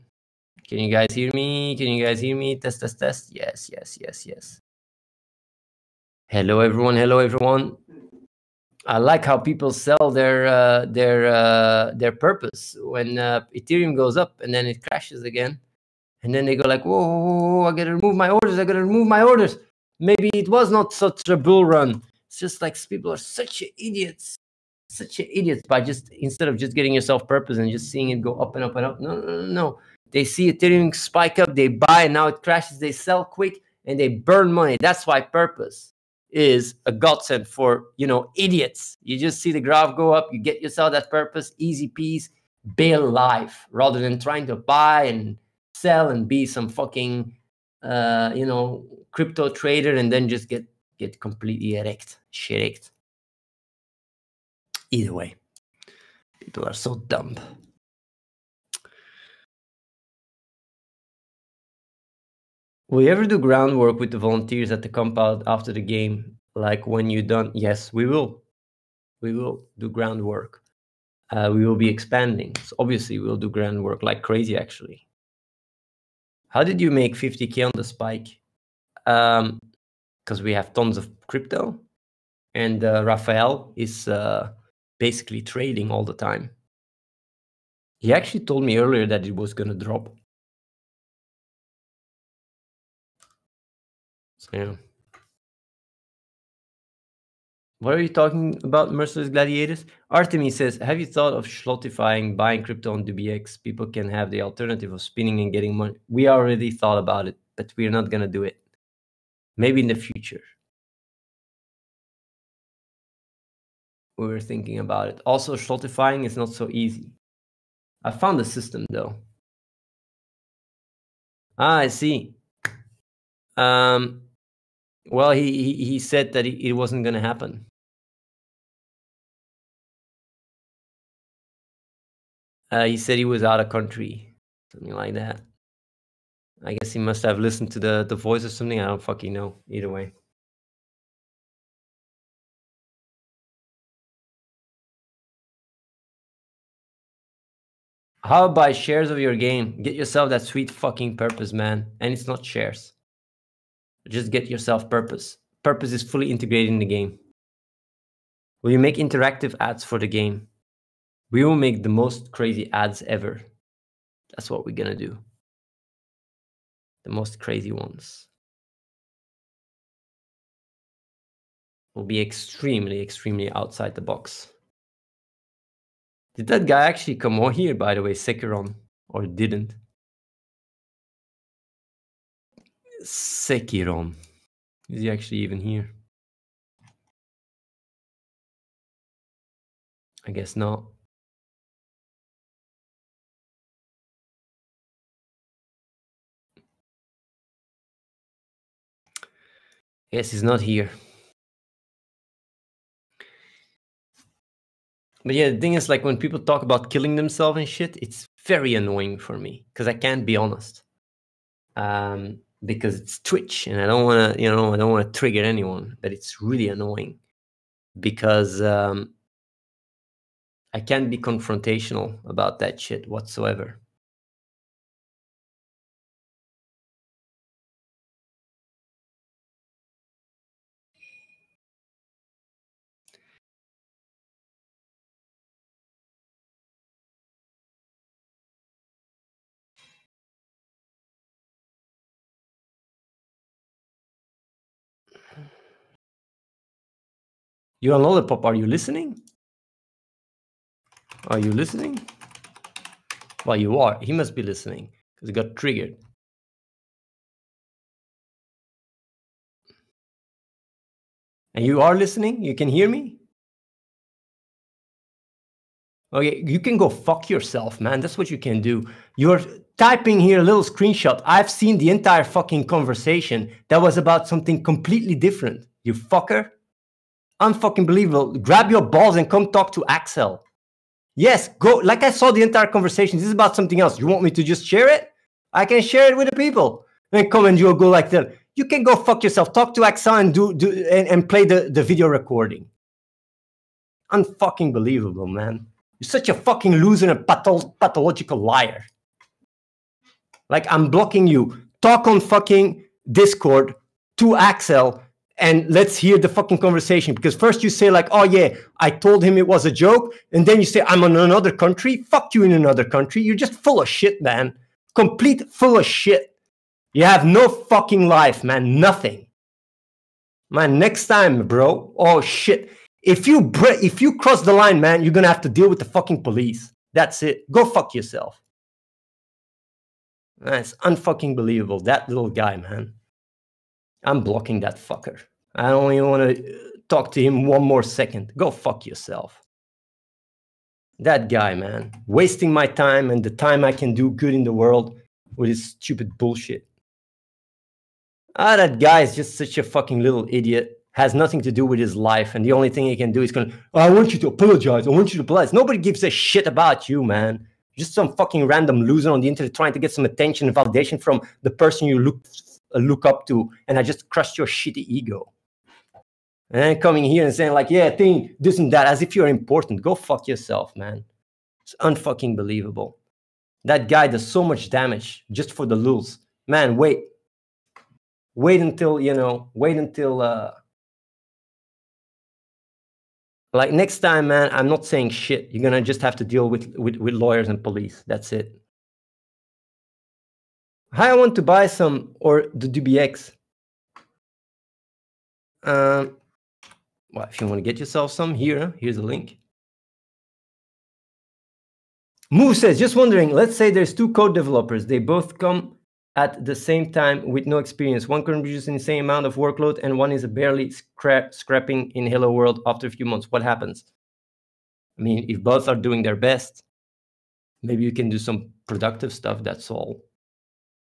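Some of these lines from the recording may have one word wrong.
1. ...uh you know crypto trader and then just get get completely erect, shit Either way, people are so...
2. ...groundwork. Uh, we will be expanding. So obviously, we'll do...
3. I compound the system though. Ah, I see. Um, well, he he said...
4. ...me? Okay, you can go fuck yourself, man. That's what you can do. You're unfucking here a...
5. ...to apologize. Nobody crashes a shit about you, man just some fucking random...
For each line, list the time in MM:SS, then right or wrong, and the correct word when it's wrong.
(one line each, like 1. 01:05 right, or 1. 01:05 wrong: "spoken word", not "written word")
1. 00:47 right
2. 01:09 right
3. 01:58 wrong: "found", not "compound"
4. 04:22 wrong: "typing", not "unfucking"
5. 05:55 wrong: "gives", not "crashes".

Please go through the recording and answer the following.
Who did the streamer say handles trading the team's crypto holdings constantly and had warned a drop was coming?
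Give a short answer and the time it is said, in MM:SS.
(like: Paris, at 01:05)
Rafael, at 01:23.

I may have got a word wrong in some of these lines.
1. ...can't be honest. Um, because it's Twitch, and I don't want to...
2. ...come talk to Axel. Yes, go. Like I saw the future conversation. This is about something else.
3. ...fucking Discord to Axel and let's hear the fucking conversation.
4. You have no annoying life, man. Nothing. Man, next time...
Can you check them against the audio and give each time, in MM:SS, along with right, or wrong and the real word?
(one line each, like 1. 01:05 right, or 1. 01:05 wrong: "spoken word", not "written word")
1. 03:29 right
2. 04:39 wrong: "entire", not "future"
3. 05:02 right
4. 05:16 wrong: "fucking", not "annoying".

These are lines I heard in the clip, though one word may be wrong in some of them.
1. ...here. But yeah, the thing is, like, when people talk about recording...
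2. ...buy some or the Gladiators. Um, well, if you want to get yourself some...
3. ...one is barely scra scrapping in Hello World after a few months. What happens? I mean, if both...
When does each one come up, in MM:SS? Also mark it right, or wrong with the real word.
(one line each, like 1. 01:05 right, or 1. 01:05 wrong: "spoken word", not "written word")
1. 03:20 wrong: "killing", not "recording"
2. 06:31 wrong: "DBX", not "Gladiators"
3. 06:49 right.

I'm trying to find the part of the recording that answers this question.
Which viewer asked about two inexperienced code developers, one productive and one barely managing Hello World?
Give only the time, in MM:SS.
06:42.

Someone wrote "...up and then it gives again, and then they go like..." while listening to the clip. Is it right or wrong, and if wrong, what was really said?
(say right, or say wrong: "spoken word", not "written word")
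wrong: "crashes", not "gives".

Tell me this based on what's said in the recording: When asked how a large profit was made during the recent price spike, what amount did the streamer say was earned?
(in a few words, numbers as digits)
50K.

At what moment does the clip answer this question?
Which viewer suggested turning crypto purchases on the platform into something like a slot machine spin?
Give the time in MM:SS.
01:40.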